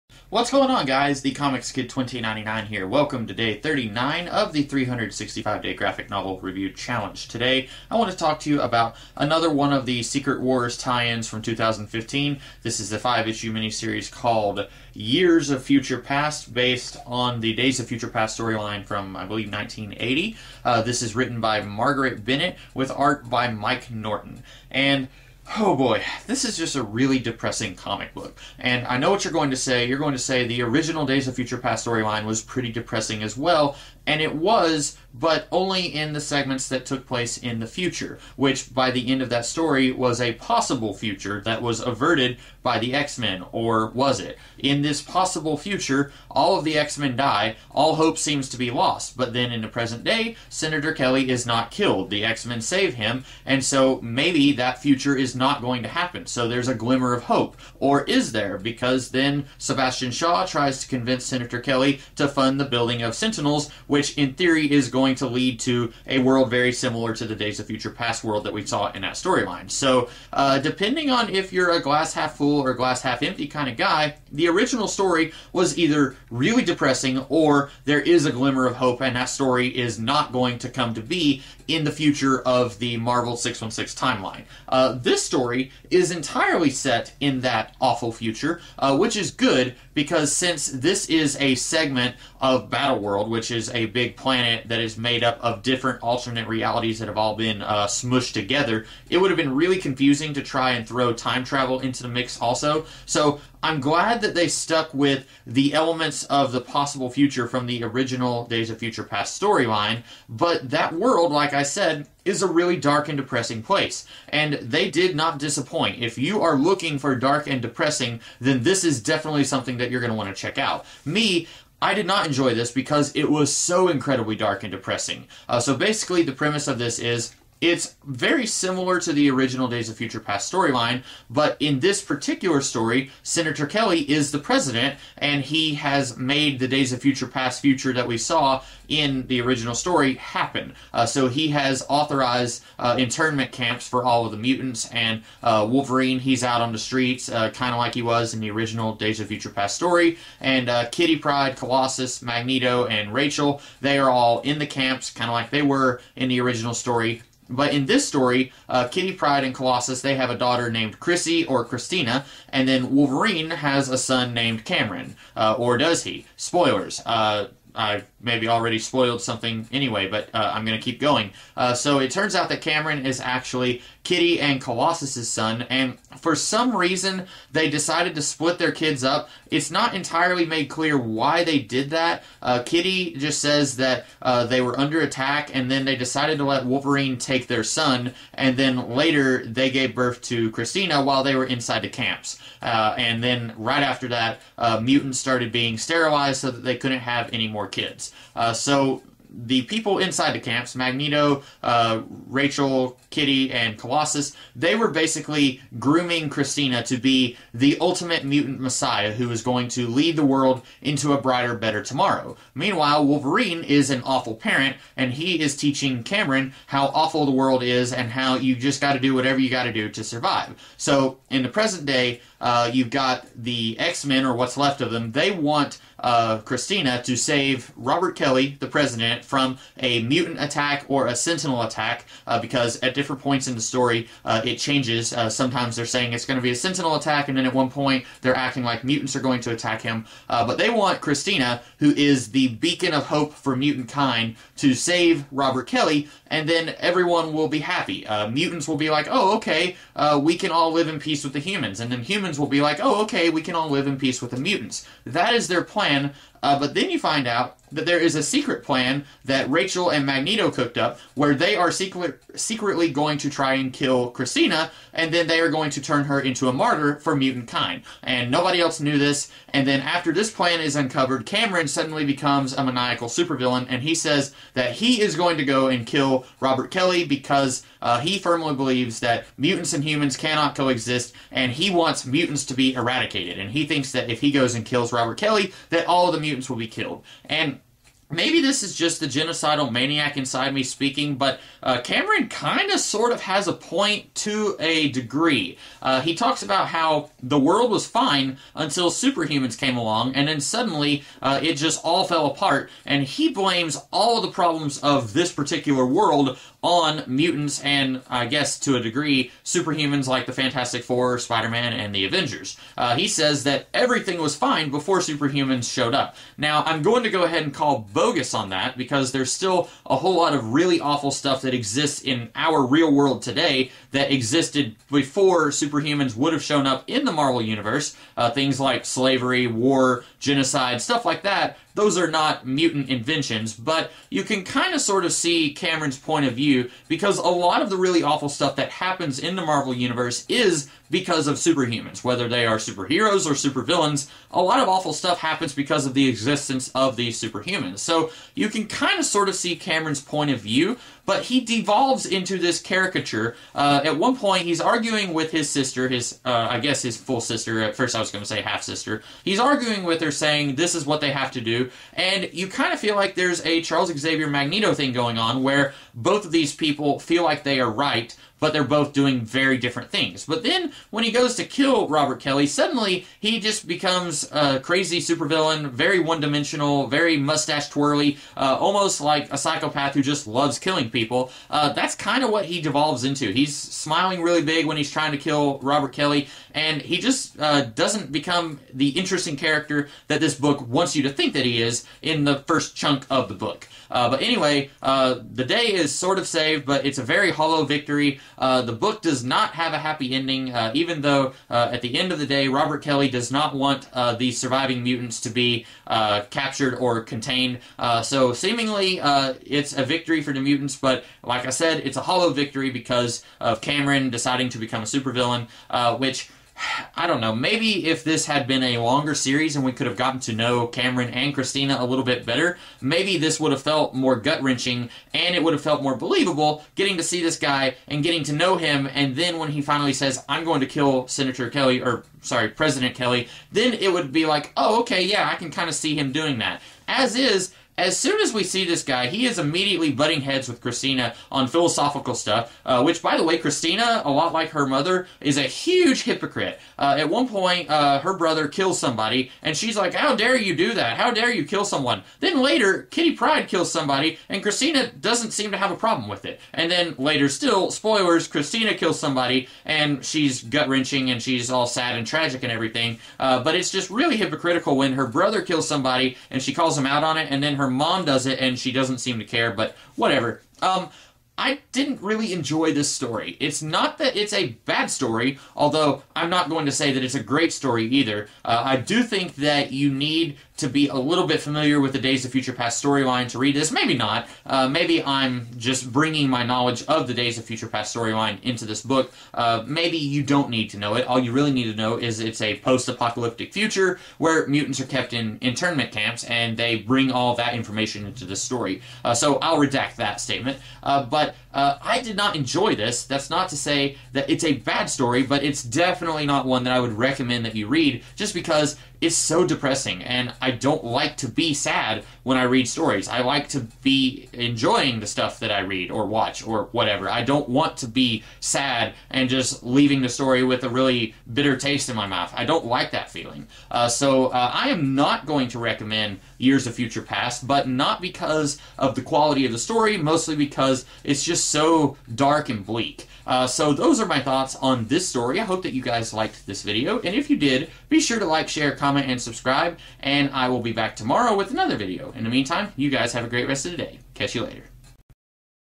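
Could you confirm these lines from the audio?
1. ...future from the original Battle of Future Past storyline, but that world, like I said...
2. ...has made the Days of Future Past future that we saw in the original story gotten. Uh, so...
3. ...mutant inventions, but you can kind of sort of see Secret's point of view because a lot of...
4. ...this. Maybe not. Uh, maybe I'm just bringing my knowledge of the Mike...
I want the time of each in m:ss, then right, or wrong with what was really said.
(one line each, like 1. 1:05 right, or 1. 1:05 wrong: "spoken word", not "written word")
1. 1:47 wrong: "Days", not "Battle"
2. 2:15 wrong: "happen", not "gotten"
3. 5:32 wrong: "Cameron", not "Secret"
4. 8:03 wrong: "Days", not "Mike".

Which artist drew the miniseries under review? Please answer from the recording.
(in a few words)
Mike Norton.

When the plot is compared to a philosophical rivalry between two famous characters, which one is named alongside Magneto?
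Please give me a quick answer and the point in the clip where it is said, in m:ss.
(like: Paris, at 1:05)
Charles Xavier, at 6:03.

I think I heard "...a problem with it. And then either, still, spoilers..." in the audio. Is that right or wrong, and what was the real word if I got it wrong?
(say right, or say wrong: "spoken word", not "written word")
wrong: "later", not "either".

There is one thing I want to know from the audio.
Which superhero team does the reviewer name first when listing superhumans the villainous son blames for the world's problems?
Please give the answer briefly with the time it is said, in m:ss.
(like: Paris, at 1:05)
Fantastic Four, at 5:10.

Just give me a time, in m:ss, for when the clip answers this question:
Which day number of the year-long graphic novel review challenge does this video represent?
0:03.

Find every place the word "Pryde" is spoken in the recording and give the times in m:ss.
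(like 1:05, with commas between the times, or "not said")
2:31, 2:39, 7:33.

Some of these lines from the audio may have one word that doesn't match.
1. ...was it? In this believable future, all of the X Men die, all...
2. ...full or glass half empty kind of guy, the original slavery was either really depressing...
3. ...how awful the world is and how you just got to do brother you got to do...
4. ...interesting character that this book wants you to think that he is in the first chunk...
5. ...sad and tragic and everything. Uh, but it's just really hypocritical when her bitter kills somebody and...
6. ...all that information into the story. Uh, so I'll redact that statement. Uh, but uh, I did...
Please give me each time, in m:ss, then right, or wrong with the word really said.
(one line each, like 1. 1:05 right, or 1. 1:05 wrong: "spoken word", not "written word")
1. 0:43 wrong: "possible", not "believable"
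2. 1:12 wrong: "story", not "slavery"
3. 3:36 wrong: "whatever", not "brother"
4. 6:28 right
5. 7:41 wrong: "brother", not "bitter"
6. 8:17 right.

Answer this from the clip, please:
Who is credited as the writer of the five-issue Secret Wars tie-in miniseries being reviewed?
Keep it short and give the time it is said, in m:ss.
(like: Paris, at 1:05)
Marguerite Bennett, at 0:21.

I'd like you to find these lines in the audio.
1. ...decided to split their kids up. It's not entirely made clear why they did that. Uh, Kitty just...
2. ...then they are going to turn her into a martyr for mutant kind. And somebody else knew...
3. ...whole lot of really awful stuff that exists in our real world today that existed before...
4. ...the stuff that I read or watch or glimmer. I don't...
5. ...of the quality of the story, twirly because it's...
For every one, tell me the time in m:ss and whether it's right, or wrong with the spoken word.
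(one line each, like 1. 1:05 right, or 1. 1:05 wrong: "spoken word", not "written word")
1. 2:57 right
2. 4:25 wrong: "nobody", not "somebody"
3. 5:19 right
4. 8:34 wrong: "whatever", not "glimmer"
5. 8:48 wrong: "mostly", not "twirly".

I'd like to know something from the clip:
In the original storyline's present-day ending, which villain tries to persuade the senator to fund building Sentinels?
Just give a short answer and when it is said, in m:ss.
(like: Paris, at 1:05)
Sebastian Shaw, at 0:59.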